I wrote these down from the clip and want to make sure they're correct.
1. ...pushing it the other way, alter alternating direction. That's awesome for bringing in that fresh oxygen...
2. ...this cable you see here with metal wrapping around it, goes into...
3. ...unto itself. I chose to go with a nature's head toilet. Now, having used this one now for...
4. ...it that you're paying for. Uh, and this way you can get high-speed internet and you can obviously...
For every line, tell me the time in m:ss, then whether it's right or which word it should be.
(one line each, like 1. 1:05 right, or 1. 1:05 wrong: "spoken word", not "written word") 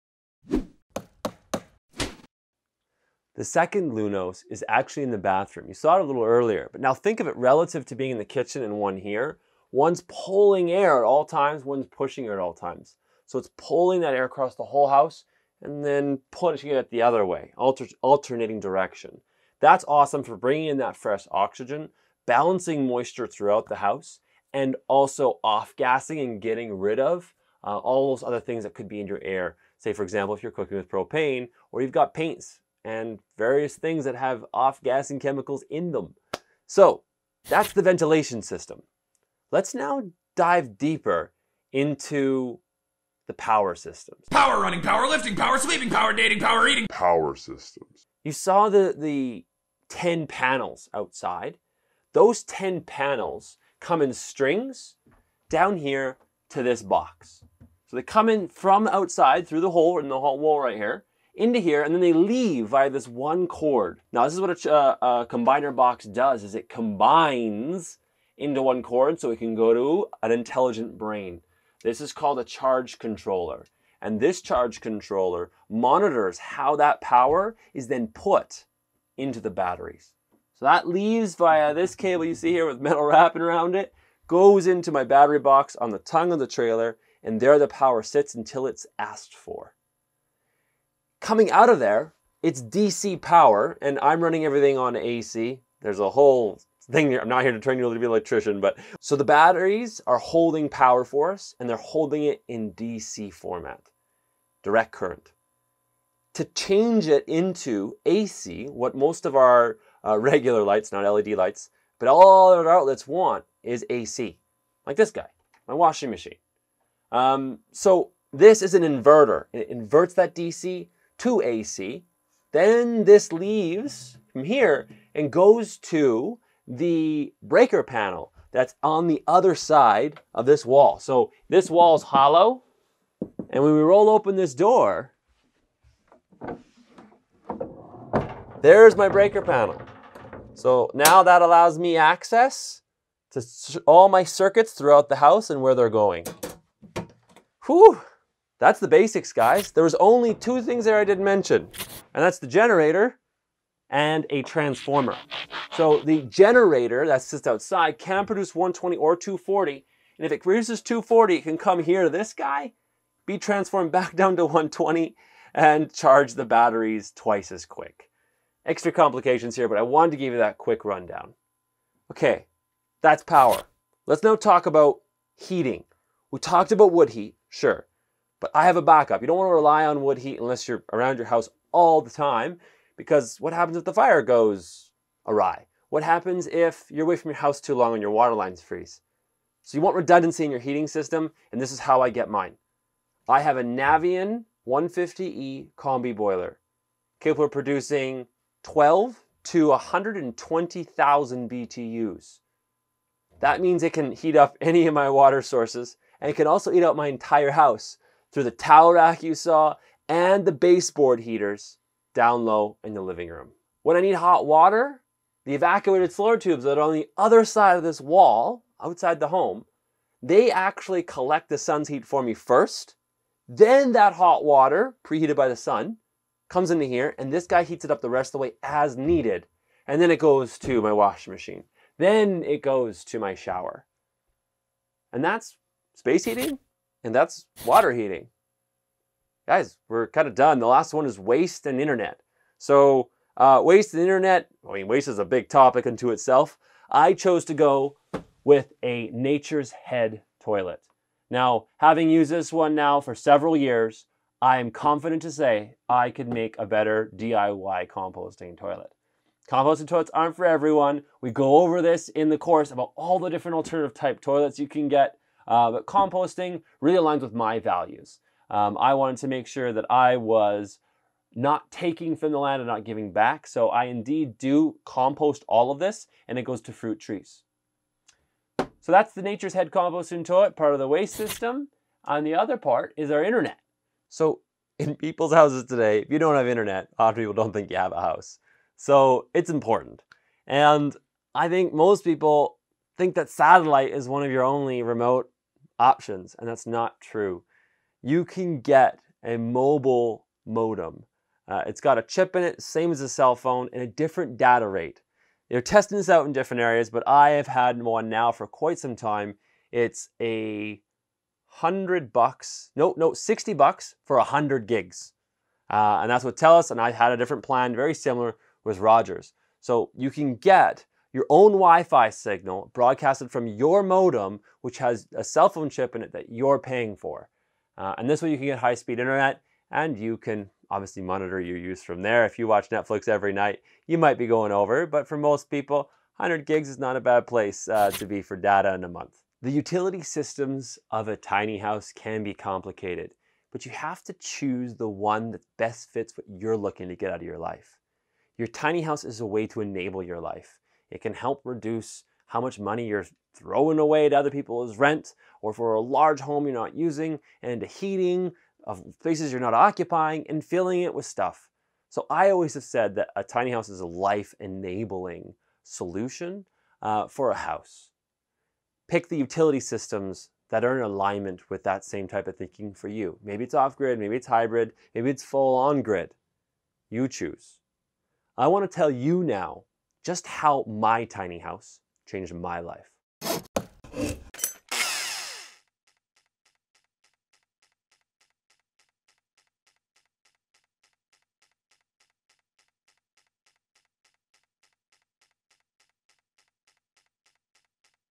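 1. 0:16 right
2. 1:21 right
3. 4:05 right
4. 5:26 right.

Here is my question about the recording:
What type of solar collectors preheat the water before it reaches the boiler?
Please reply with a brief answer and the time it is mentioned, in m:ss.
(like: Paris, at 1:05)
Evacuated solar tubes, at 3:35.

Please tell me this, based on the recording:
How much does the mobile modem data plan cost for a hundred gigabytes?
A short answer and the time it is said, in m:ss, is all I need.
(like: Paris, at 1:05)
$60, at 5:13.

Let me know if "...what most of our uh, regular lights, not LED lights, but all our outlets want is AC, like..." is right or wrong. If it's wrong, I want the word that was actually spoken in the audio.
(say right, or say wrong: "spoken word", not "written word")
right.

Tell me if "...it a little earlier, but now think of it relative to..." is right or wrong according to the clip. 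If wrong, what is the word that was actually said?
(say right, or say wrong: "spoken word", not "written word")
right.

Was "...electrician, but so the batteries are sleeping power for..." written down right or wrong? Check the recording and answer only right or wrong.
wrong.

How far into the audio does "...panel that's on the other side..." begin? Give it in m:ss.
2:07.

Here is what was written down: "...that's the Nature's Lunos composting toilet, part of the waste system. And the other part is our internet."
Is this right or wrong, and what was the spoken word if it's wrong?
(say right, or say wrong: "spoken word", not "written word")
wrong: "Head", not "Lunos".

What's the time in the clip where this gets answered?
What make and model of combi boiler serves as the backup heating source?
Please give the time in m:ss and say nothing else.
3:13.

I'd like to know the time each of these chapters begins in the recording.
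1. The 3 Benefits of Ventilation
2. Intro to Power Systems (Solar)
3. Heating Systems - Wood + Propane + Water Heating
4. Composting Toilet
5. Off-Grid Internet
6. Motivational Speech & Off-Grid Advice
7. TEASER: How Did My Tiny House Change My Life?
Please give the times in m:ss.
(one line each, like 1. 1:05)
1. 0:20
2. 0:38
3. 2:55
4. 4:05
5. 4:40
6. 5:38
7. 6:16.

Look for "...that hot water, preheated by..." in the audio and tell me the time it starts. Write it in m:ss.
3:43.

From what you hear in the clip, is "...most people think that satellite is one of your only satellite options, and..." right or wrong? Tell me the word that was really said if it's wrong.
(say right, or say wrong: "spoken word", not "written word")
wrong: "remote", not "satellite".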